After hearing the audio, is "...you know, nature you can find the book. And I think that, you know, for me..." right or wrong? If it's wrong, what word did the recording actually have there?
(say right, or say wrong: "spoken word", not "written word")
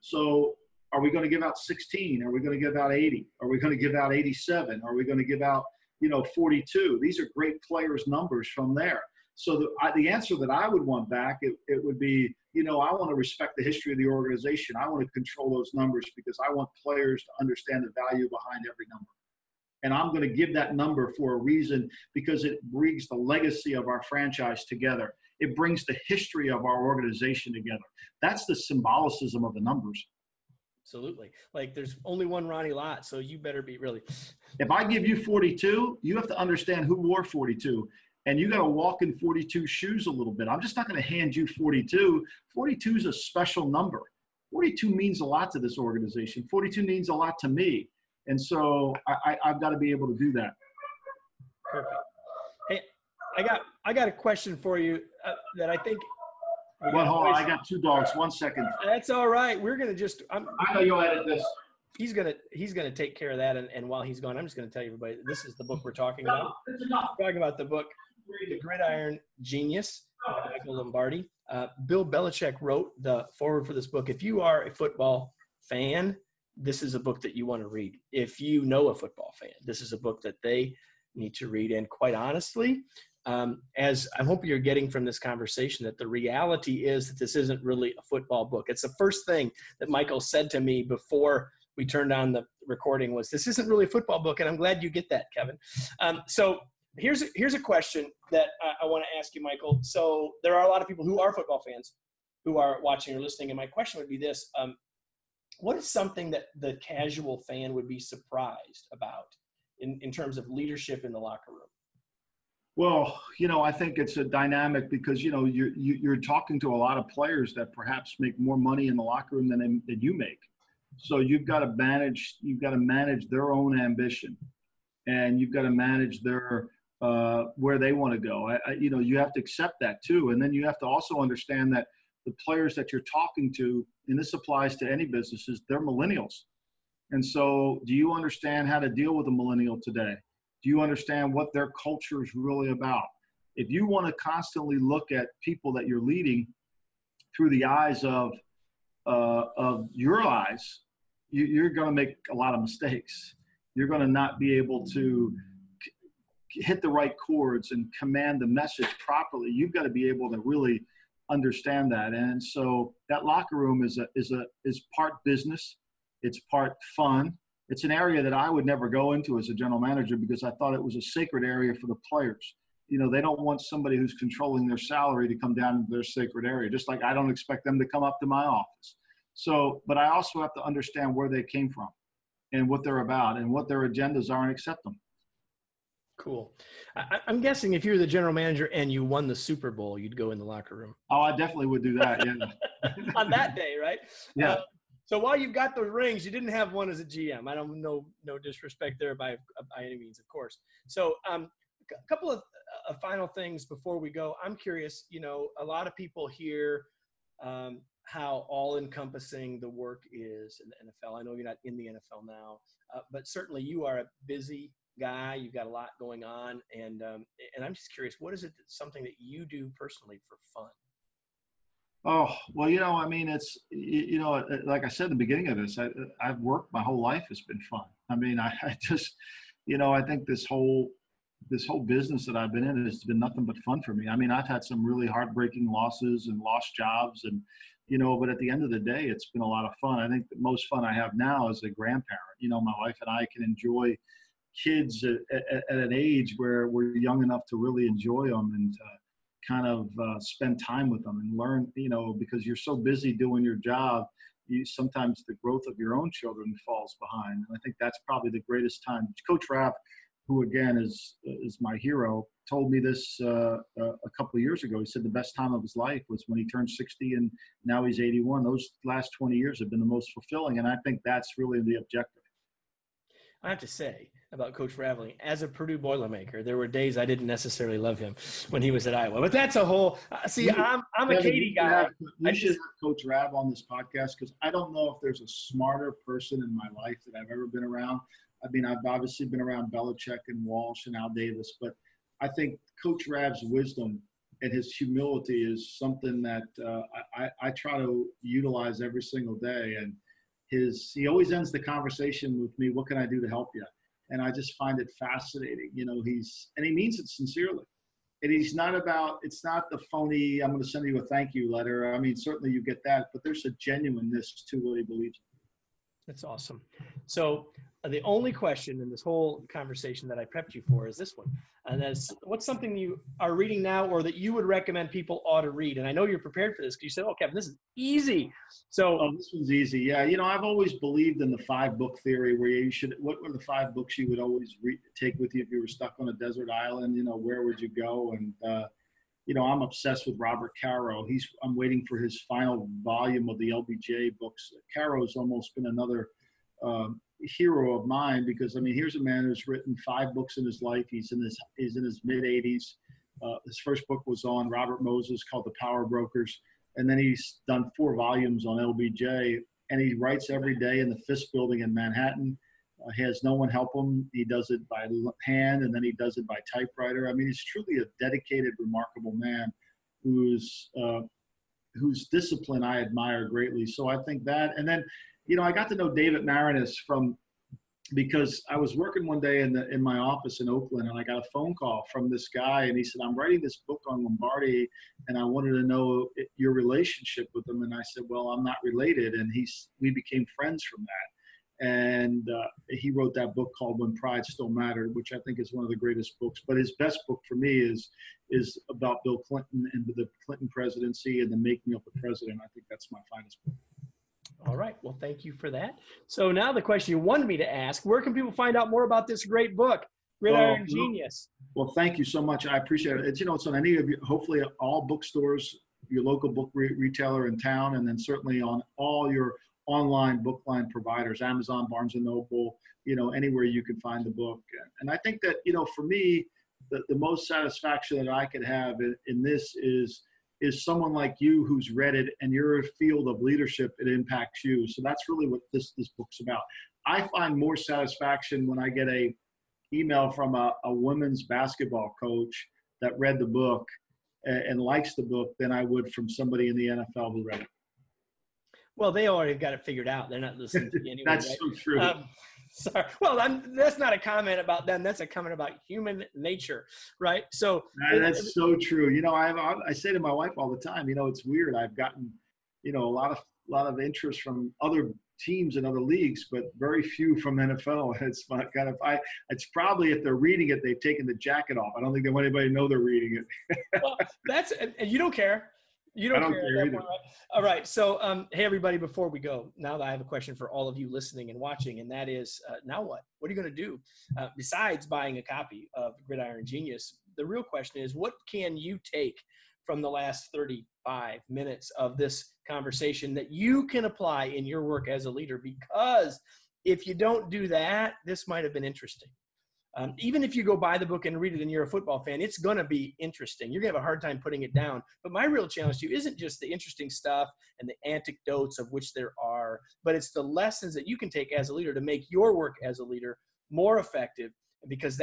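wrong: "anywhere", not "nature".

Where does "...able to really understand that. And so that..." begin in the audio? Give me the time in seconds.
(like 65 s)
160 s.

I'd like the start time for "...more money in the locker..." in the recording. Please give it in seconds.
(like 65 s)
118 s.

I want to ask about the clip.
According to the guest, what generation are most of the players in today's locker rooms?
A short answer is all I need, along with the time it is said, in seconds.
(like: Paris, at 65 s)
millennials, at 135 s.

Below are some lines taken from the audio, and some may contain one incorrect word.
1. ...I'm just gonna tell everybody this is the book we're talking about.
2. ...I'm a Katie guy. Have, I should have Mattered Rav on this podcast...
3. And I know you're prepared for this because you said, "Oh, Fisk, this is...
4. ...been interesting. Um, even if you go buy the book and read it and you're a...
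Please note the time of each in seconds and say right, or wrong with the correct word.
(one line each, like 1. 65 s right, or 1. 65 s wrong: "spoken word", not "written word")
1. 64 s right
2. 280 s wrong: "Coach", not "Mattered"
3. 325 s wrong: "Kevin", not "Fisk"
4. 498 s right.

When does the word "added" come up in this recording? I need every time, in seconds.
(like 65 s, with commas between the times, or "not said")
not said.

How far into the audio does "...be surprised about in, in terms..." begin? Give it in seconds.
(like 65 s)
107 s.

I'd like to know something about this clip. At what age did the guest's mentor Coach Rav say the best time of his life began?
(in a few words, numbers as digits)
60.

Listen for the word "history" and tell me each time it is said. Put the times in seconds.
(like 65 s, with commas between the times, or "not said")
13 s, 26 s.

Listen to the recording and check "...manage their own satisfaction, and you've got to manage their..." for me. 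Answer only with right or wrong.
wrong.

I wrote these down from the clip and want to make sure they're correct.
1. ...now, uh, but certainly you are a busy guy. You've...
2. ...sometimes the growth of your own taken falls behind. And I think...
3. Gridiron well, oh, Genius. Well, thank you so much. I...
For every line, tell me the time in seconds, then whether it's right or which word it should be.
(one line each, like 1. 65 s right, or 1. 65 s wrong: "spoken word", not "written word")
1. 212 s right
2. 254 s wrong: "children", not "taken"
3. 410 s right.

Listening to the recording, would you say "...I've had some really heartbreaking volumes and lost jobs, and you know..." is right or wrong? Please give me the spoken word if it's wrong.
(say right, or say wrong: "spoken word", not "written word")
wrong: "losses", not "volumes".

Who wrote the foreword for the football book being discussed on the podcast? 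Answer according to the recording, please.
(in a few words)
Bill Belichick.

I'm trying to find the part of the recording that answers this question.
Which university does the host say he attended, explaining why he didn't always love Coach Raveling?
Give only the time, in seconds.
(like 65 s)
275 s.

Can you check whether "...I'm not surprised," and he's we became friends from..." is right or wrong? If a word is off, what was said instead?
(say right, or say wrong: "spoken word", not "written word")
wrong: "related", not "surprised".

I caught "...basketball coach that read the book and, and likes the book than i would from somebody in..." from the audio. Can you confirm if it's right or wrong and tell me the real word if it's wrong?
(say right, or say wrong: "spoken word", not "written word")
right.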